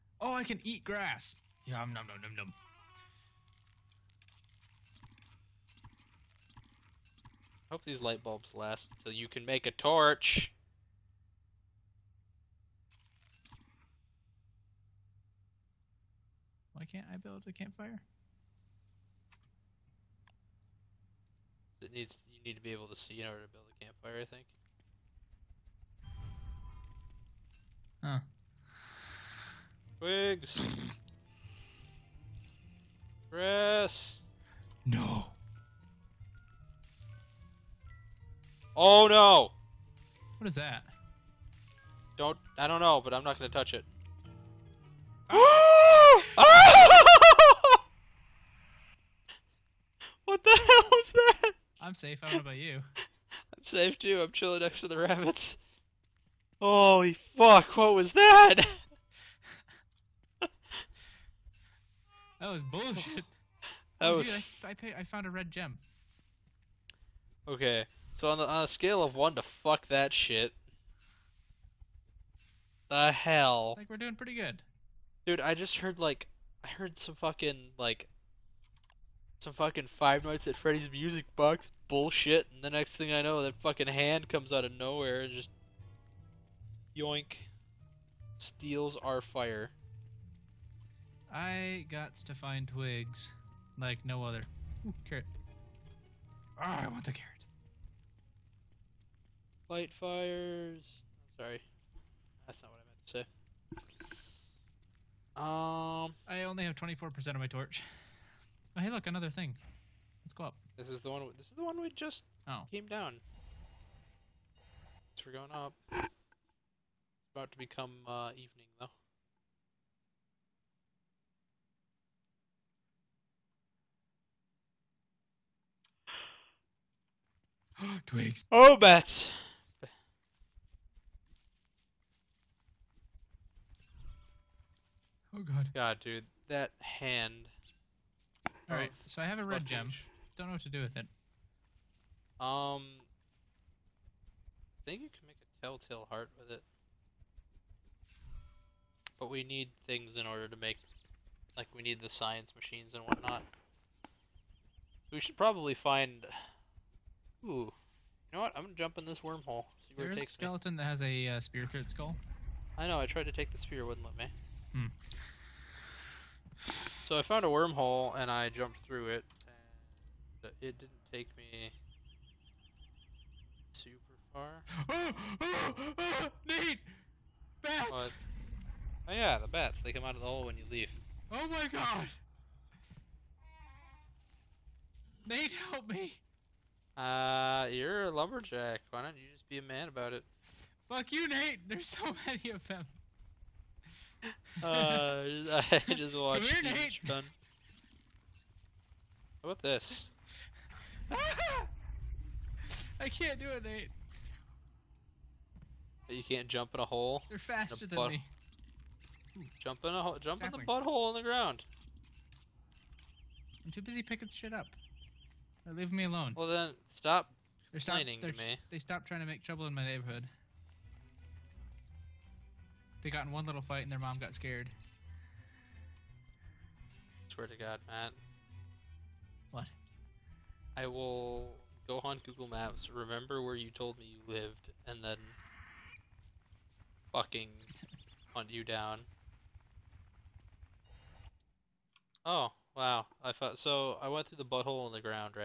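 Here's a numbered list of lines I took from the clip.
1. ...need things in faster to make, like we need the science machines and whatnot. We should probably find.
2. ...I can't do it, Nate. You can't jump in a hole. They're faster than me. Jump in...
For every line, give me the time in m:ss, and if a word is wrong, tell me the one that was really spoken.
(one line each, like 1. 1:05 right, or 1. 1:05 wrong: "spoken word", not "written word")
1. 2:29 wrong: "order", not "faster"
2. 3:22 right.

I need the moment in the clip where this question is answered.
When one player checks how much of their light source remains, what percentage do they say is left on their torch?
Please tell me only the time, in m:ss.
1:46.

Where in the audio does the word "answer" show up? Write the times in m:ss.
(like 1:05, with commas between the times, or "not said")
not said.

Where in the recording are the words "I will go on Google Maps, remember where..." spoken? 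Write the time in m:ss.
3:50.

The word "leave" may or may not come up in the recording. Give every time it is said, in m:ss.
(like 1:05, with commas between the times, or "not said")
3:00, 3:35.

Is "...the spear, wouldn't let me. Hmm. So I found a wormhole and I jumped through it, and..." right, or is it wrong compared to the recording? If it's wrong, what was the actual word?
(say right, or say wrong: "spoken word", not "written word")
right.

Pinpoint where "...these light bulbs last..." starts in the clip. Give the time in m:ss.
0:07.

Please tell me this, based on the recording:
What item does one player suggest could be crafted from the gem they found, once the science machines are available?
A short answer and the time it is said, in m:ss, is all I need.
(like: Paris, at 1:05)
Telltale heart, at 2:25.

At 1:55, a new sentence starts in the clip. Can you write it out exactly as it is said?
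It's about to become uh, evening, though.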